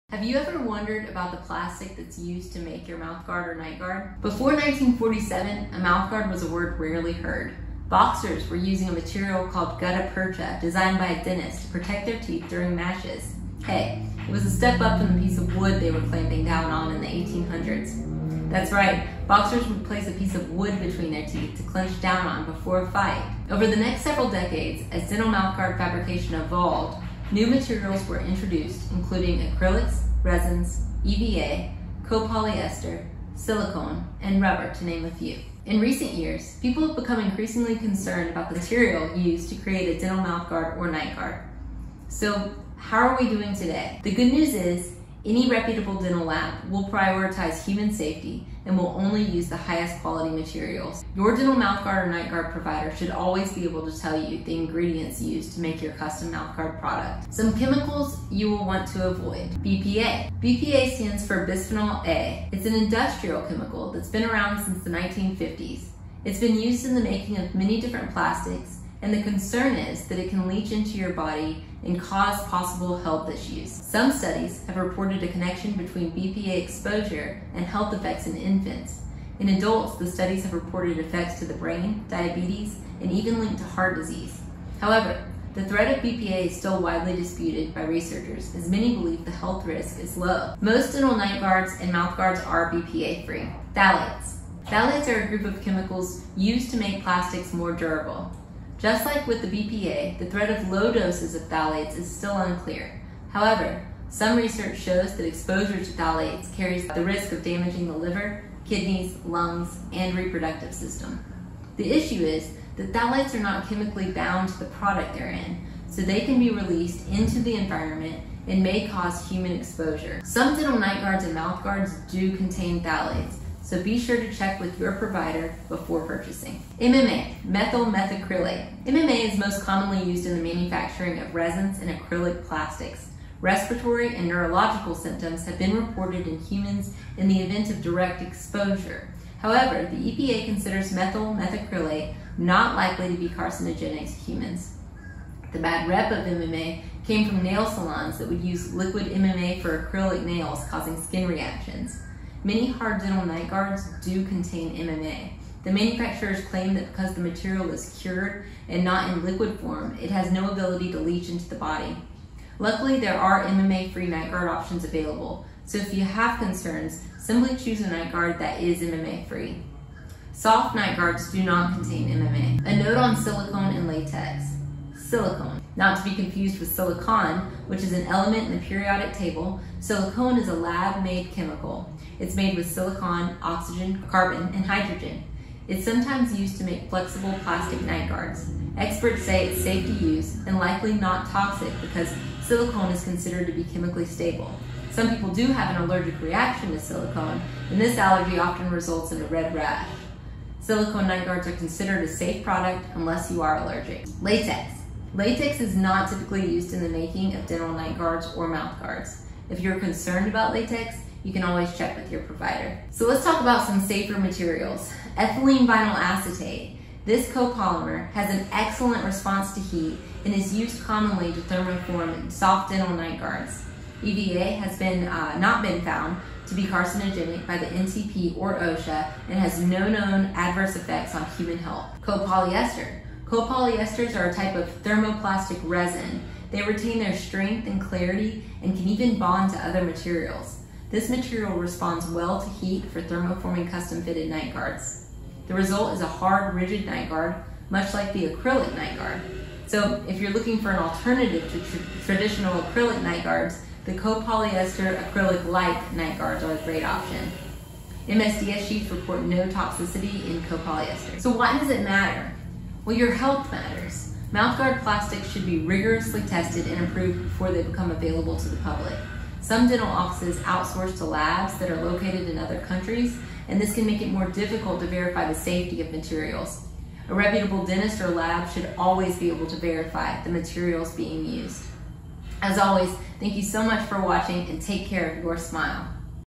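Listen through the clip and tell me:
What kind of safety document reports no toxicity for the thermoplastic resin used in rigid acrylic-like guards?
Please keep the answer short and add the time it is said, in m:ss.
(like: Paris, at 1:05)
MSDS sheets, at 4:18.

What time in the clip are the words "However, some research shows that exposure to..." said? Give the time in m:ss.
1:43.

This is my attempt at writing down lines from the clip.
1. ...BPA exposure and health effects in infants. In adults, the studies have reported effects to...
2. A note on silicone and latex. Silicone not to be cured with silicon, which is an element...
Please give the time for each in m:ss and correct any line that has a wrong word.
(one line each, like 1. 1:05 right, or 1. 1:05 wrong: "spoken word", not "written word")
1. 1:16 right
2. 2:52 wrong: "confused", not "cured".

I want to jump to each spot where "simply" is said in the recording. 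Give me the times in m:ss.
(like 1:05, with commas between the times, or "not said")
2:47.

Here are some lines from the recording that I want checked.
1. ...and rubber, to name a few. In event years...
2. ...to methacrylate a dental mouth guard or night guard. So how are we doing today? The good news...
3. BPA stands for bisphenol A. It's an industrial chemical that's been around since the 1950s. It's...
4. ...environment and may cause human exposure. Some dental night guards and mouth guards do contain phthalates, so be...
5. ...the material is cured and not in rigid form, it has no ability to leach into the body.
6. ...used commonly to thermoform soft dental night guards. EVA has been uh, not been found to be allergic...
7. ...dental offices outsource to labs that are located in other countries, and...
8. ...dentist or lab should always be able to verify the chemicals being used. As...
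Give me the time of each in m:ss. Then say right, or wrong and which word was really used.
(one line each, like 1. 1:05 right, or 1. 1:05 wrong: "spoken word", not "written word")
1. 0:34 wrong: "recent", not "event"
2. 0:39 wrong: "create", not "methacrylate"
3. 1:00 right
4. 1:57 right
5. 2:37 wrong: "liquid", not "rigid"
6. 3:40 wrong: "carcinogenic", not "allergic"
7. 4:29 right
8. 4:37 wrong: "materials", not "chemicals".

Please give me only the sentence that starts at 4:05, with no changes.
The result is a hard, rigid night guard, much like the acrylic night guard.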